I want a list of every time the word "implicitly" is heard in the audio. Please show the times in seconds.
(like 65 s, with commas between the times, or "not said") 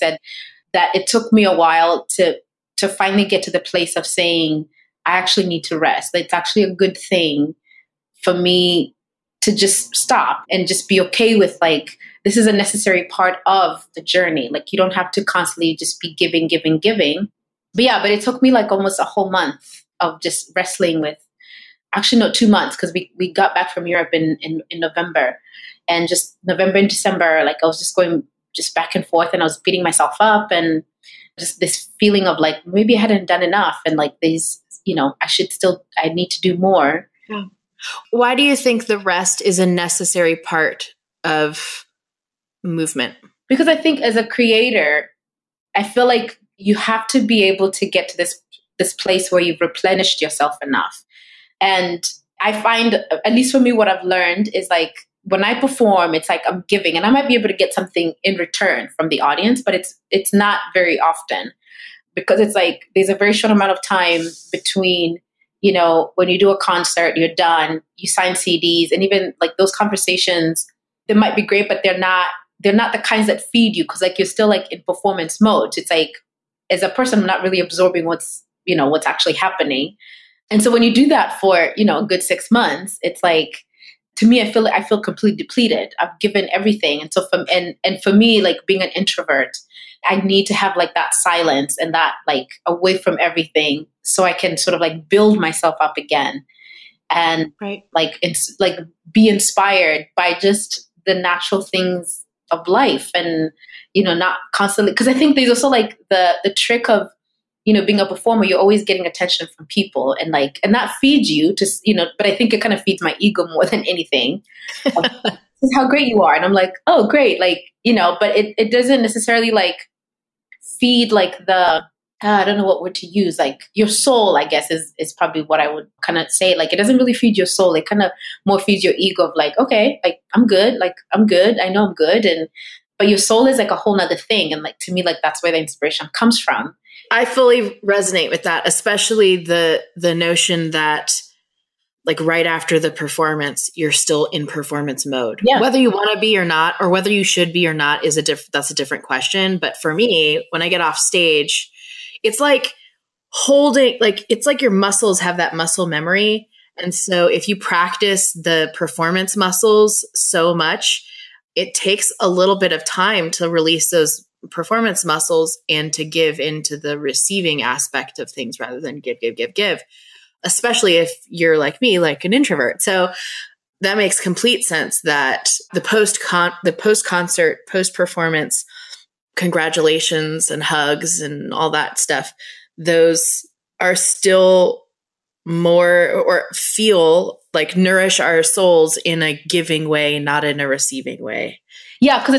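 not said.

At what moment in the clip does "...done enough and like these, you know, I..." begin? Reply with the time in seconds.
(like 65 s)
33 s.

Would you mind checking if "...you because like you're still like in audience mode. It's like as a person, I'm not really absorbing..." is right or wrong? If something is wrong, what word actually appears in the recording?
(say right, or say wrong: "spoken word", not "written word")
wrong: "performance", not "audience".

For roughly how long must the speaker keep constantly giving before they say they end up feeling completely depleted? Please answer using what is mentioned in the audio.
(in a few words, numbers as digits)
6 months.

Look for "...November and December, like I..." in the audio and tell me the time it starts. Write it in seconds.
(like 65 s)
26 s.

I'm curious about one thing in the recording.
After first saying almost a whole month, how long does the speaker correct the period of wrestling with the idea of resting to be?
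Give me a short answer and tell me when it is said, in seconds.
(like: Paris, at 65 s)
2 months, at 22 s.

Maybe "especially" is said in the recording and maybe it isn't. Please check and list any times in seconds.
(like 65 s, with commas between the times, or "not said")
138 s, 170 s.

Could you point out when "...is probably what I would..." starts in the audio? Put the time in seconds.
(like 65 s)
124 s.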